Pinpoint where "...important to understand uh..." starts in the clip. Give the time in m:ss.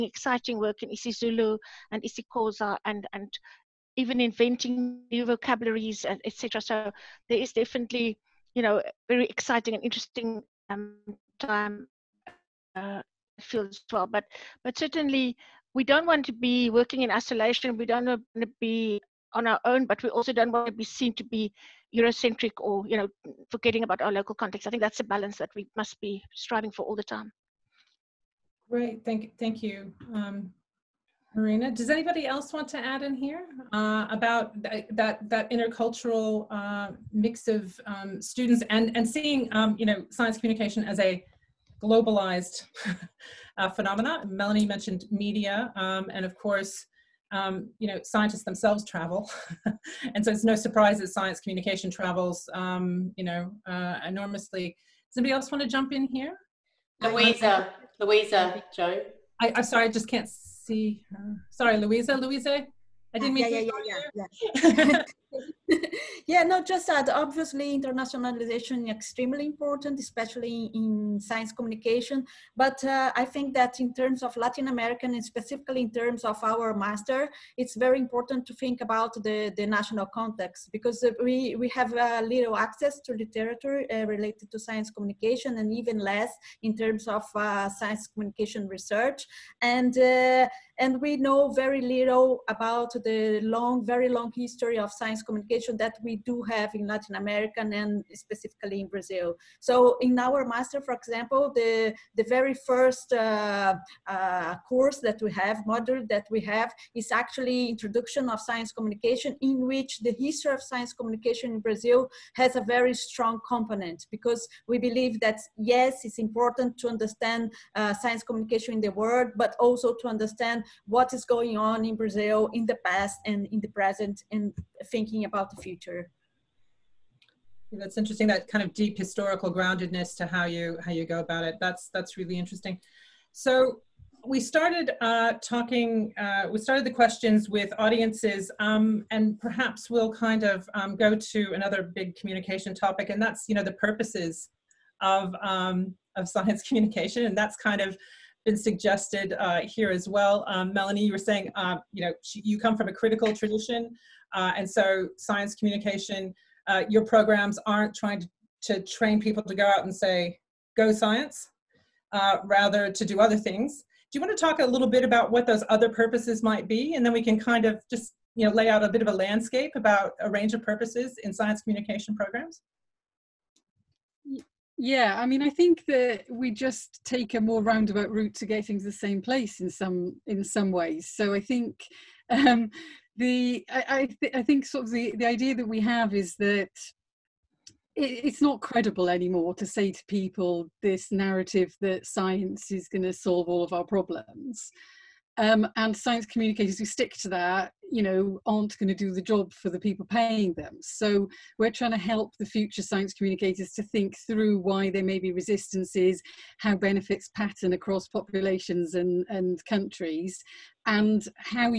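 1:56.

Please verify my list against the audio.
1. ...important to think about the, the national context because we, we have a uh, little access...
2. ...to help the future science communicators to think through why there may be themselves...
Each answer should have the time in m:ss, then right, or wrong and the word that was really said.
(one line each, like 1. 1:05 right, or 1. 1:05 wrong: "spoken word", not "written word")
1. 1:17 right
2. 3:21 wrong: "resistances", not "themselves".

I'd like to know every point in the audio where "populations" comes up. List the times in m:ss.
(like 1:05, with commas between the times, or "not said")
3:28.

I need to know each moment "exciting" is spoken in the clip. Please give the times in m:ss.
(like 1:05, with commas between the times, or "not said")
0:00, 0:09.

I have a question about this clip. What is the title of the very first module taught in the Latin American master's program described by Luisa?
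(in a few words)
Introduction of Science Communication.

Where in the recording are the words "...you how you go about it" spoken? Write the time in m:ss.
2:10.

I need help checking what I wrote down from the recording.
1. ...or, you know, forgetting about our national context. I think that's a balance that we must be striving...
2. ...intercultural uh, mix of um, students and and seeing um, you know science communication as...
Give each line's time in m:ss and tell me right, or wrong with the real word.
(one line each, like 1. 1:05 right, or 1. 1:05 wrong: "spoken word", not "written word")
1. 0:22 wrong: "local", not "national"
2. 0:35 right.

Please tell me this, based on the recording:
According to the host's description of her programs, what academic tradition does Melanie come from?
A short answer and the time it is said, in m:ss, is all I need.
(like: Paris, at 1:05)
critical tradition, at 2:32.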